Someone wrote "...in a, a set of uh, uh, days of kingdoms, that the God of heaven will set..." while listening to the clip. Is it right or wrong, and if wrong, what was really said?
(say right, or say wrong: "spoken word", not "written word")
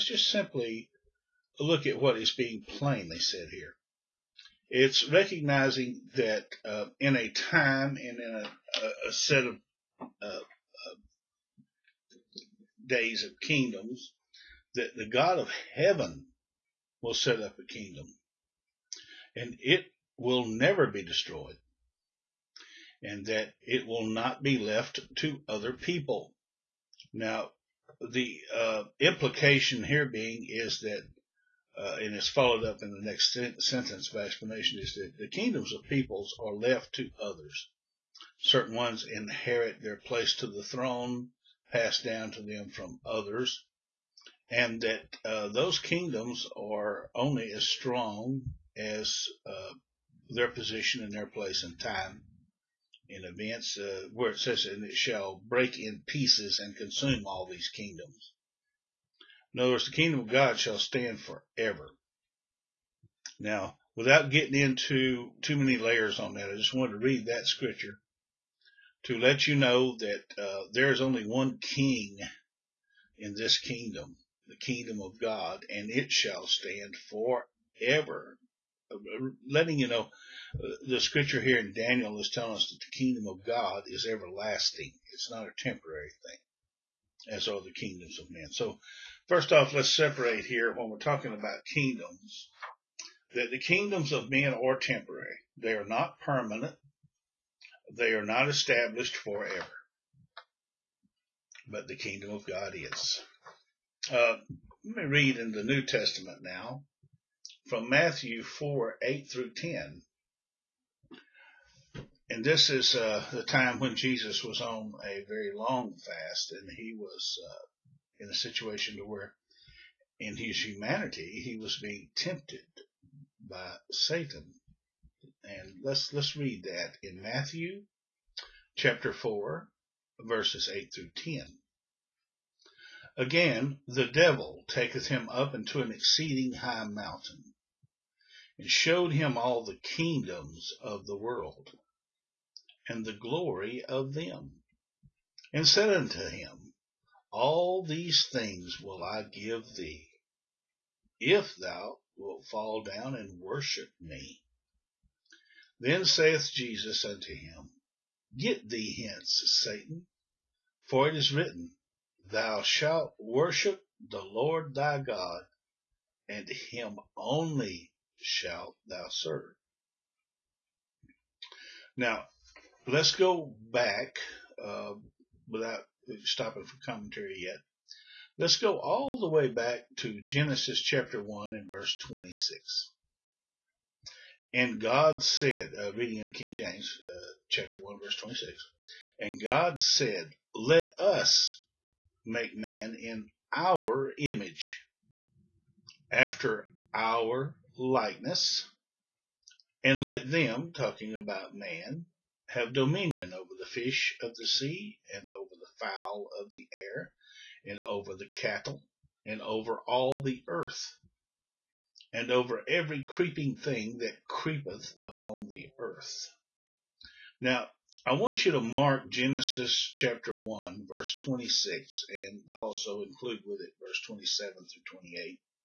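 right.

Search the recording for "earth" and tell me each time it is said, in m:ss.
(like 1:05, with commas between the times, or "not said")
3:30, 3:35.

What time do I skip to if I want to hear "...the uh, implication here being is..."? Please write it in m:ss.
0:27.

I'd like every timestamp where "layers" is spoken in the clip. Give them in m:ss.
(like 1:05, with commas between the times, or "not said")
1:05.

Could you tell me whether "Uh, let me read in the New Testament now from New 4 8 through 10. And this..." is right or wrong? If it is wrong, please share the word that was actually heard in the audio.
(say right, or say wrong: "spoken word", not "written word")
wrong: "Matthew", not "New".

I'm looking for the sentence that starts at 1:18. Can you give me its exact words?
Uh, uh, letting you know, uh, the scripture here in Daniel is telling us that the kingdom of God is everlasting.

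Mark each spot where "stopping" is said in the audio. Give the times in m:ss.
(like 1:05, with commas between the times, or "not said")
2:56.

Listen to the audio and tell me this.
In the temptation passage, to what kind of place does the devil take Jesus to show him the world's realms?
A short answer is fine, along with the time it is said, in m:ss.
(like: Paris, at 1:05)
An exceeding high mountain, at 2:15.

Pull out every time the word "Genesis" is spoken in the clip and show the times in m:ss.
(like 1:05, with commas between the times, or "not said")
3:00, 3:39.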